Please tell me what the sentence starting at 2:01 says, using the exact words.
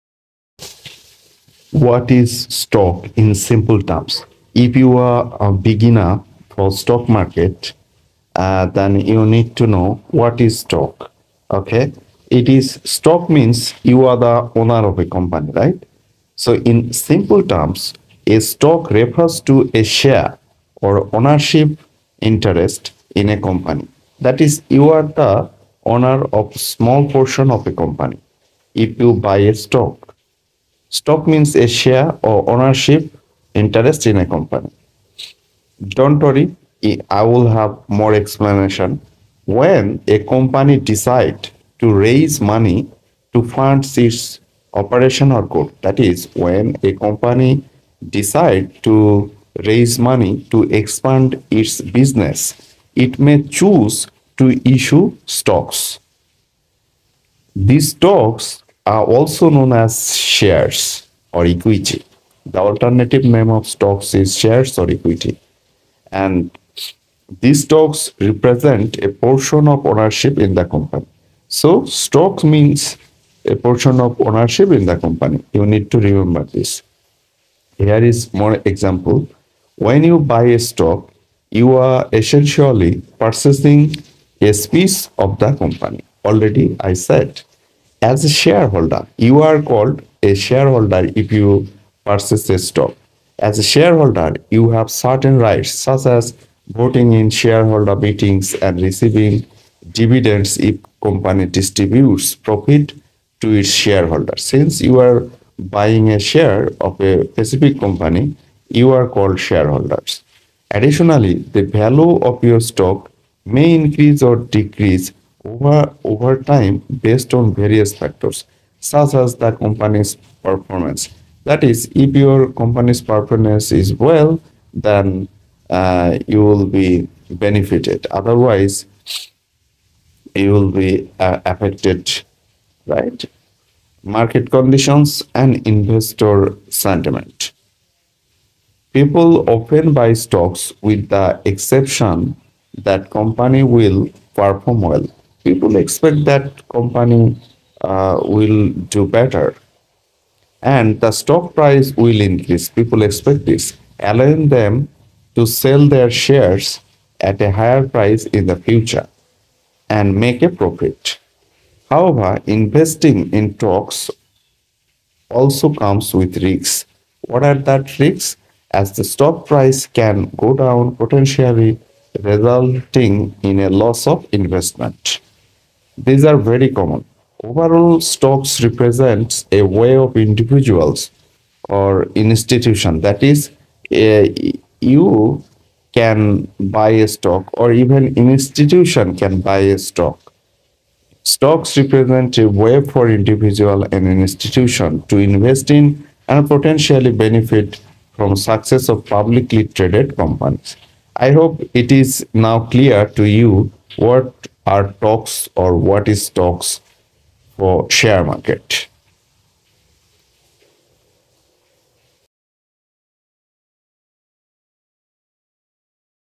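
That is, if your company's performance is well, then uh, you will be benefited.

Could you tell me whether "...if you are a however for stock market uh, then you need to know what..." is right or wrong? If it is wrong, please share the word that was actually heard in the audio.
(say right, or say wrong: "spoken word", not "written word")
wrong: "beginner", not "however".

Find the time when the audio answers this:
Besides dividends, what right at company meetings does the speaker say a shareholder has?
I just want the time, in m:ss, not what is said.
1:36.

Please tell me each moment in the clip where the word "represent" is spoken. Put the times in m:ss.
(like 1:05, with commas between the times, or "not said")
1:08, 2:58, 3:11.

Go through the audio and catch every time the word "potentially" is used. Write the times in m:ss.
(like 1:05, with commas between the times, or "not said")
2:50, 3:16.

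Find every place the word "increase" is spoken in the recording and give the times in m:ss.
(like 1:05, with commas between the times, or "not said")
1:53, 2:32.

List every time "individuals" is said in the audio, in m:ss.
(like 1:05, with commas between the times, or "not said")
3:00, 3:13.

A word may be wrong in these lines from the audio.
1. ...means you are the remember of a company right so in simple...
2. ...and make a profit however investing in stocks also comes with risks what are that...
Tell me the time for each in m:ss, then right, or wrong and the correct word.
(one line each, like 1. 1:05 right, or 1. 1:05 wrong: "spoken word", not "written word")
1. 0:13 wrong: "owner", not "remember"
2. 2:39 right.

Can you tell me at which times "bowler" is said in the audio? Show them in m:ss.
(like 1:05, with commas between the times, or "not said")
not said.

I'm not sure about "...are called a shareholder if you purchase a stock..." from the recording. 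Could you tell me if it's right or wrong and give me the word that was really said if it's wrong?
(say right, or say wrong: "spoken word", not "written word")
right.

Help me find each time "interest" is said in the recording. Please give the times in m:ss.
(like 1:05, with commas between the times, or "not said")
0:22, 0:33.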